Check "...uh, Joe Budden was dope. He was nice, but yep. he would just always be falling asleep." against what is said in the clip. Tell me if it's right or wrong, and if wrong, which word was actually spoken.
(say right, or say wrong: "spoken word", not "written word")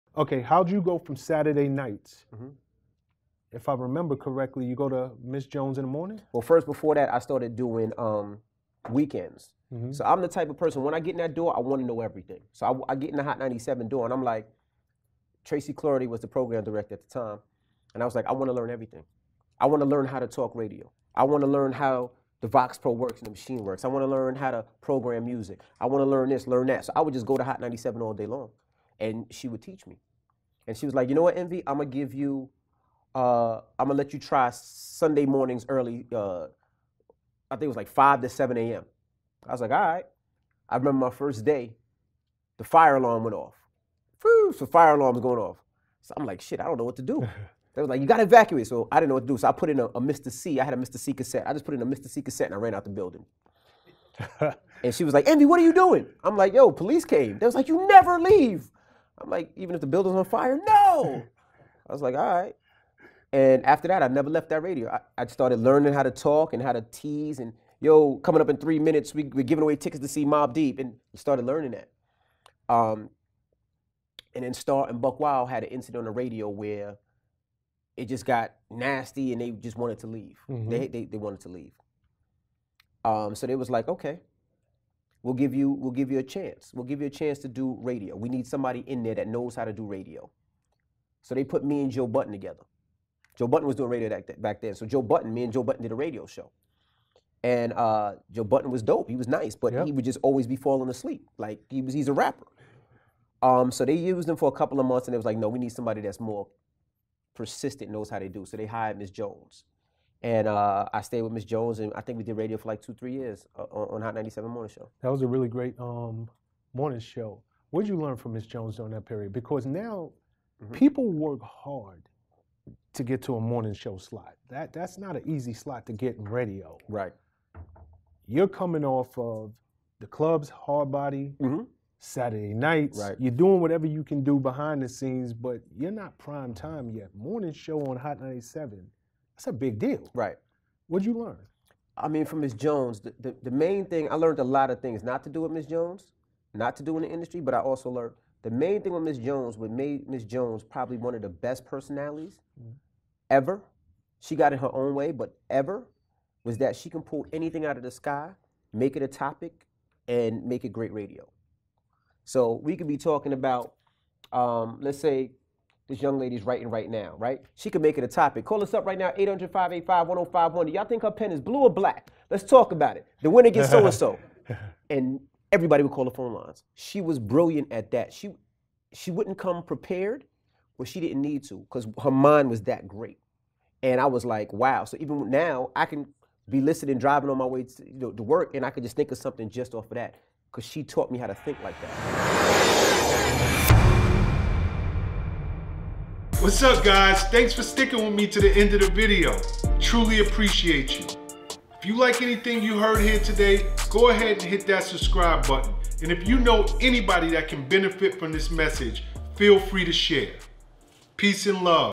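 right.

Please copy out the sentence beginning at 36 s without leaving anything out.
Uh, I think it was like five to seven a.m.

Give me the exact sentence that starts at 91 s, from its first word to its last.
So they put me and Joe Budden together.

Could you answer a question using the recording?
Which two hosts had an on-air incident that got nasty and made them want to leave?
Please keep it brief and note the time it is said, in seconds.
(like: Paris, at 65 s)
Star and Buc Wild, at 74 s.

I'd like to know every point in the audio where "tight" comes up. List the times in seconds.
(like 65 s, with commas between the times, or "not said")
not said.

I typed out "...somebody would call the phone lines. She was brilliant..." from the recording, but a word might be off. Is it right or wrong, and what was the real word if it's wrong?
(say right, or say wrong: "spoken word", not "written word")
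wrong: "everybody", not "somebody".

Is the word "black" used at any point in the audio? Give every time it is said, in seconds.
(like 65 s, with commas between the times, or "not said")
171 s.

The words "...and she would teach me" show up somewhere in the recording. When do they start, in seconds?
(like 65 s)
29 s.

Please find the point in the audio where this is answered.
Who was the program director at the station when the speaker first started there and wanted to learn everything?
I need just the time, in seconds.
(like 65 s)
15 s.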